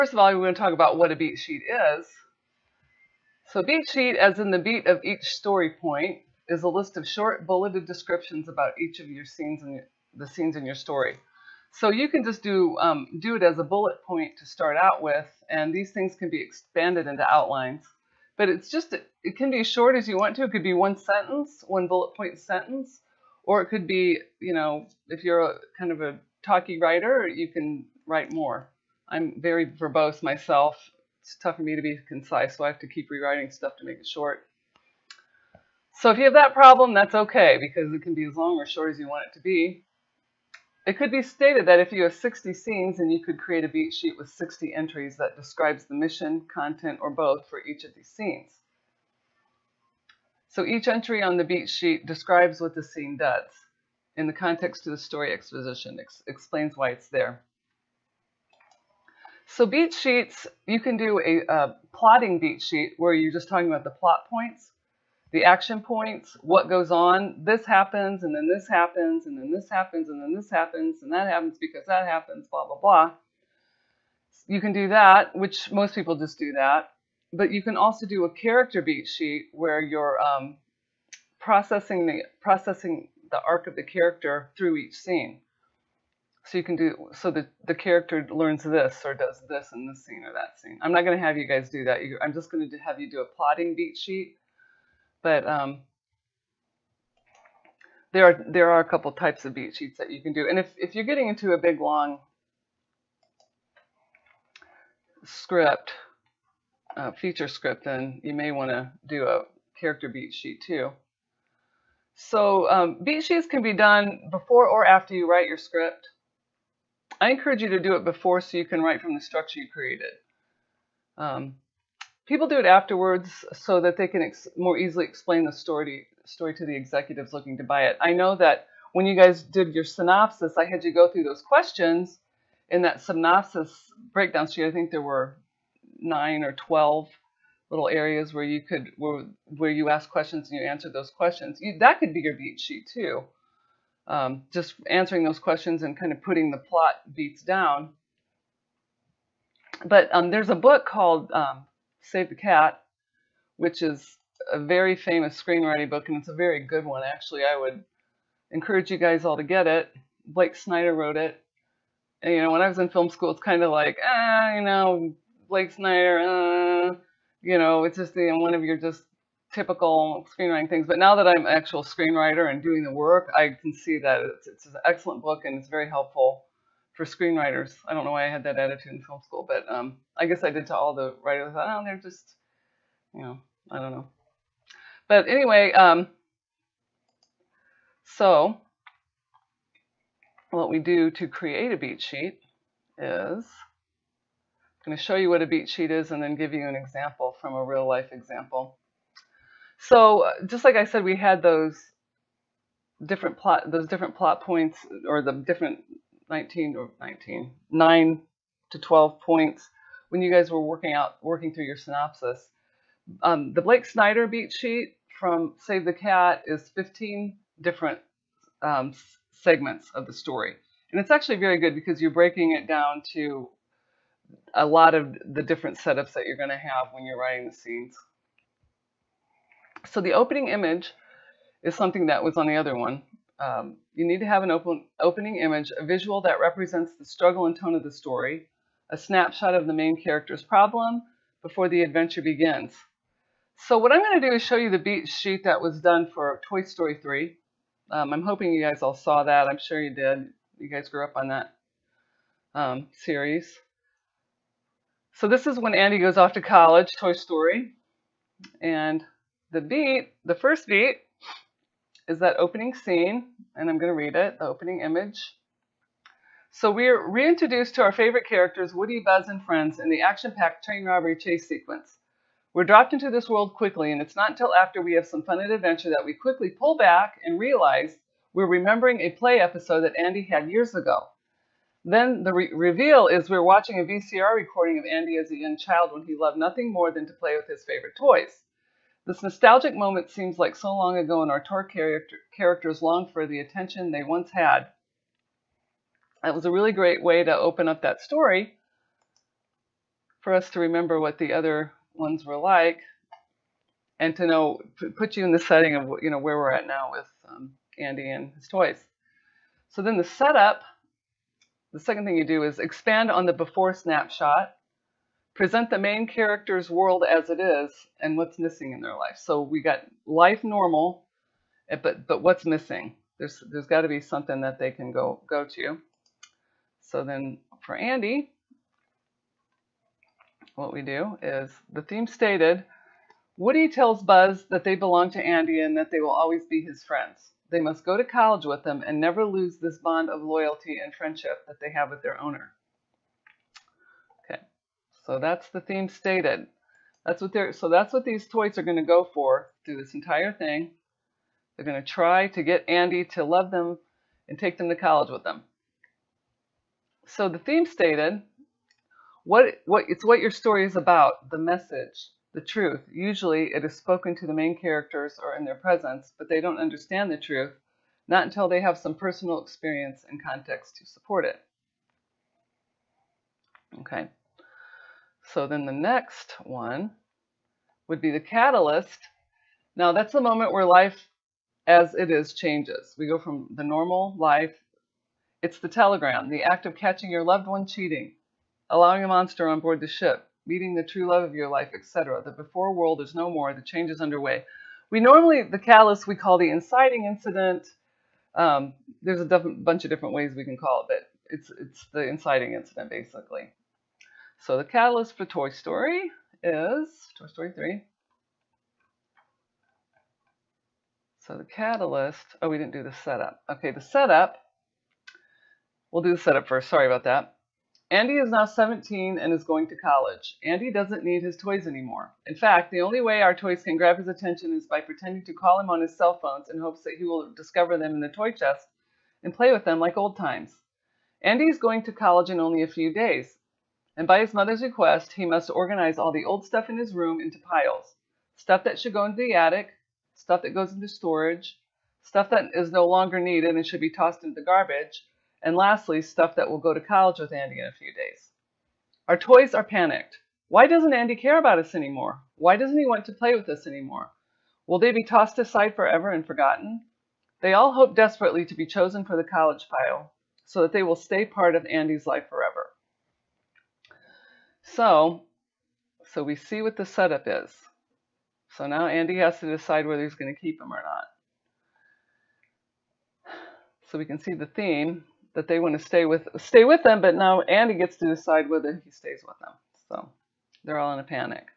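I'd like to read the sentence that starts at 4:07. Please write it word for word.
Um, I'm hoping you guys all saw that.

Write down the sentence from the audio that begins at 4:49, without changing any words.
This nostalgic moment seems like so long ago, and our tour character- characters long for the attention they once had.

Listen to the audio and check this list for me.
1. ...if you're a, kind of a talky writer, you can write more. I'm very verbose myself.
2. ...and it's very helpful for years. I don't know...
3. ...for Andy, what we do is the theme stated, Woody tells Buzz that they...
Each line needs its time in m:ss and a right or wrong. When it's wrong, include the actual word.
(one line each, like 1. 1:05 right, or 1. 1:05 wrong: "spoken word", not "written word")
1. 0:25 right
2. 2:55 wrong: "screenwriters", not "years"
3. 5:27 right.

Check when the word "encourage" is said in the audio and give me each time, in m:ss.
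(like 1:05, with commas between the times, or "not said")
1:57, 2:38.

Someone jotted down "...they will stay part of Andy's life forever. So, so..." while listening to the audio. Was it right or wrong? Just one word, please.
right.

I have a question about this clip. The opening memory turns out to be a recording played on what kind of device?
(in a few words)
VCR.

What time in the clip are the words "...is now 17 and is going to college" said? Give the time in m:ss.
6:58.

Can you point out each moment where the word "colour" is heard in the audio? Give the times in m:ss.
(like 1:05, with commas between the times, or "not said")
not said.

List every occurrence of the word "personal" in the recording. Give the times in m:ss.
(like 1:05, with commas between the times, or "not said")
6:08.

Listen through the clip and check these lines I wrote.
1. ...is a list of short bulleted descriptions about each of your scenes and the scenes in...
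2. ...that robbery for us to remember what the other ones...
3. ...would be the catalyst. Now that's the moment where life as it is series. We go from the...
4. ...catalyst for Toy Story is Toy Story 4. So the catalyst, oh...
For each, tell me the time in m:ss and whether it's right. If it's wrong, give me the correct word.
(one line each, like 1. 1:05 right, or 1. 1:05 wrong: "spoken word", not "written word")
1. 0:06 right
2. 4:57 wrong: "story", not "robbery"
3. 6:17 wrong: "changes", not "series"
4. 6:44 wrong: "3", not "4".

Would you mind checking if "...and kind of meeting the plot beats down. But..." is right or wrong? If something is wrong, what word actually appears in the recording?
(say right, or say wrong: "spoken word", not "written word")
wrong: "putting", not "meeting".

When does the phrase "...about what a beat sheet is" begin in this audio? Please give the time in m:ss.
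0:00.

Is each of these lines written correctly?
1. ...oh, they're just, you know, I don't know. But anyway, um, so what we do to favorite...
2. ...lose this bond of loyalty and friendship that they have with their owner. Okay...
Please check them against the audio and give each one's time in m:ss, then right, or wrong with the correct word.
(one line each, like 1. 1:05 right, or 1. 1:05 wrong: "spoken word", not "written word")
1. 3:01 wrong: "create", not "favorite"
2. 5:39 right.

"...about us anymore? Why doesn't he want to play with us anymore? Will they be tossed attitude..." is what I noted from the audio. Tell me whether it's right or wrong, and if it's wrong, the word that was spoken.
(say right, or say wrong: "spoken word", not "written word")
wrong: "aside", not "attitude".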